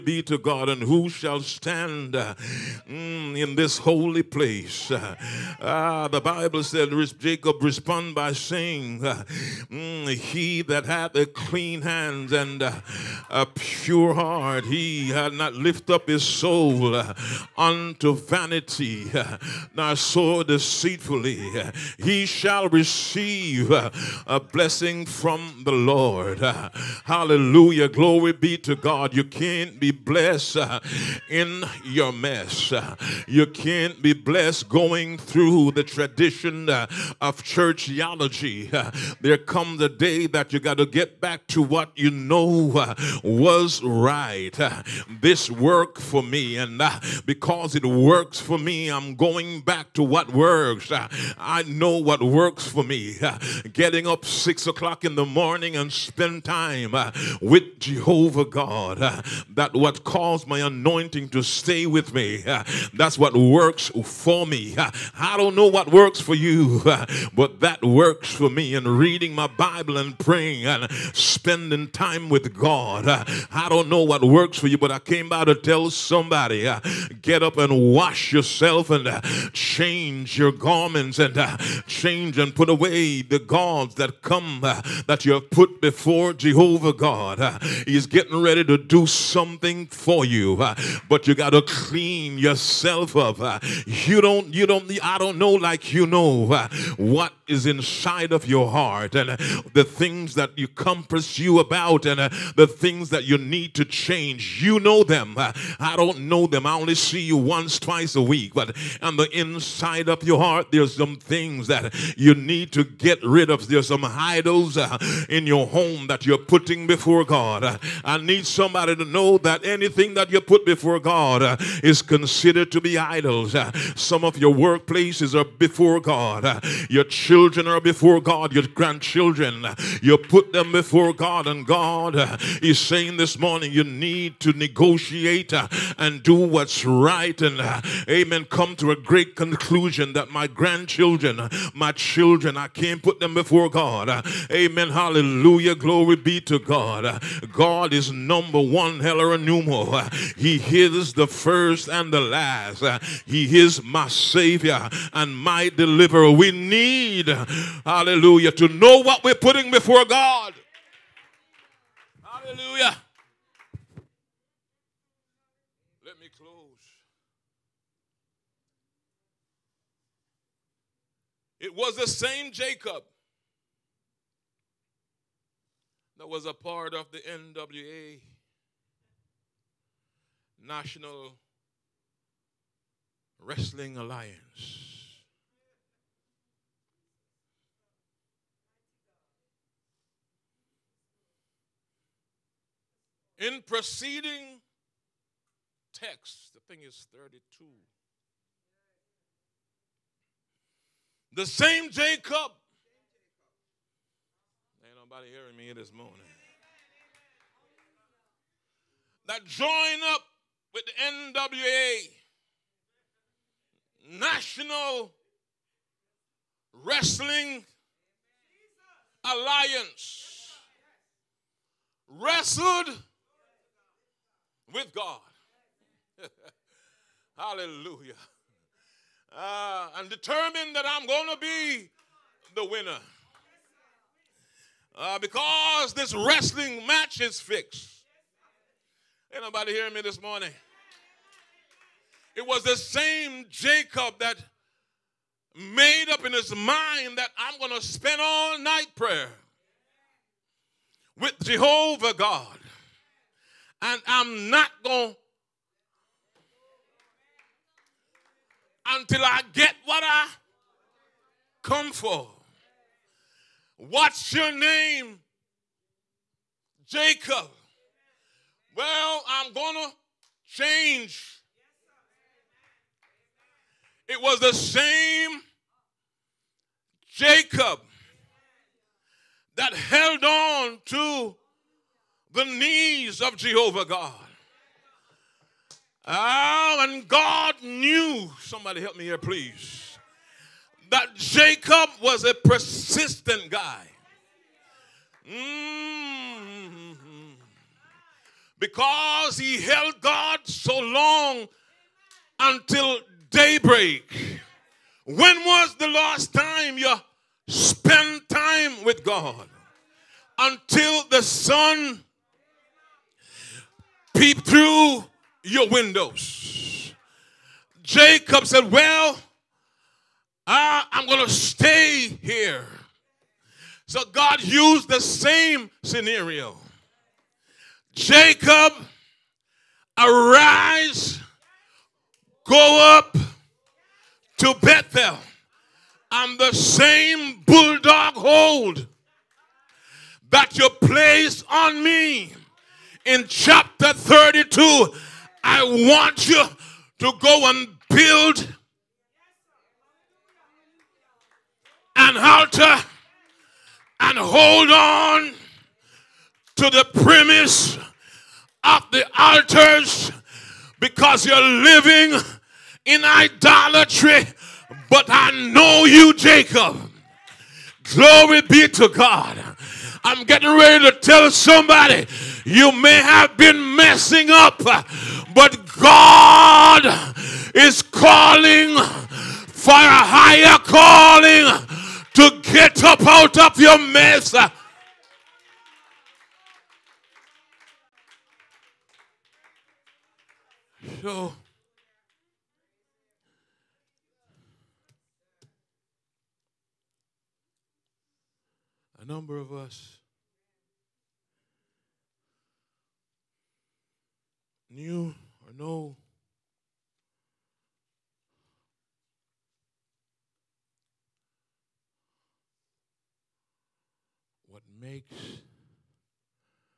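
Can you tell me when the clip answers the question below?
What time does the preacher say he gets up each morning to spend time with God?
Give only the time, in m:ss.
0:54.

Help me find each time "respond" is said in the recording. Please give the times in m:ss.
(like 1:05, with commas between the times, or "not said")
0:07.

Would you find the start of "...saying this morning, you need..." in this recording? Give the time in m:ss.
2:12.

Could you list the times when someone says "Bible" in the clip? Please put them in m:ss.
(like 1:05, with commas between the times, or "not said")
0:06, 1:09.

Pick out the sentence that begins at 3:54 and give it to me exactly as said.
Uh, because this wrestling match is fixed.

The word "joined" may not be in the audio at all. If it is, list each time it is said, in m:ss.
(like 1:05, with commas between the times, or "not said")
3:29.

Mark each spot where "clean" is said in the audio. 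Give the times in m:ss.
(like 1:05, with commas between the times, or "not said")
0:11, 1:31.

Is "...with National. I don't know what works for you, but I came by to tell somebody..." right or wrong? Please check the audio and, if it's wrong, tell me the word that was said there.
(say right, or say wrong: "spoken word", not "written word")
wrong: "God", not "National".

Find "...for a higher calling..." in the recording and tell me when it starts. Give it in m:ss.
6:19.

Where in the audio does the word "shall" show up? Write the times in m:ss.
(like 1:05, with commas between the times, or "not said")
0:01, 0:22.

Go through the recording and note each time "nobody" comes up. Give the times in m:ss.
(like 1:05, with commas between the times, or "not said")
3:24, 3:59.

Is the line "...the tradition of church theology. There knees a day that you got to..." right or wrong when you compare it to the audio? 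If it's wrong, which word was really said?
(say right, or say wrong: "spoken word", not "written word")
wrong: "comes", not "knees".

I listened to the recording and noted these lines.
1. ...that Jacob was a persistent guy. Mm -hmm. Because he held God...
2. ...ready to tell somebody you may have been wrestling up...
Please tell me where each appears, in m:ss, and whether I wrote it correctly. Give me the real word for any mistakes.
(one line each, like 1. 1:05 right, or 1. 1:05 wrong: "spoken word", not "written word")
1. 4:50 right
2. 6:10 wrong: "messing", not "wrestling".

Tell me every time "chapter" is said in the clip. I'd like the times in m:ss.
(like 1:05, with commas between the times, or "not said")
5:43.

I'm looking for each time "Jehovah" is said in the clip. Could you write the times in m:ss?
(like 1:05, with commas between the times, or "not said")
0:57, 1:26, 4:11, 4:43.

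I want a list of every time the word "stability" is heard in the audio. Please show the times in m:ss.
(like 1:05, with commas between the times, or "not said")
not said.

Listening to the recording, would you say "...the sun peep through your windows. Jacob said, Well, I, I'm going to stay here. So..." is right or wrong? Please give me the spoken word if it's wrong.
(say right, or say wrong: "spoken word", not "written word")
right.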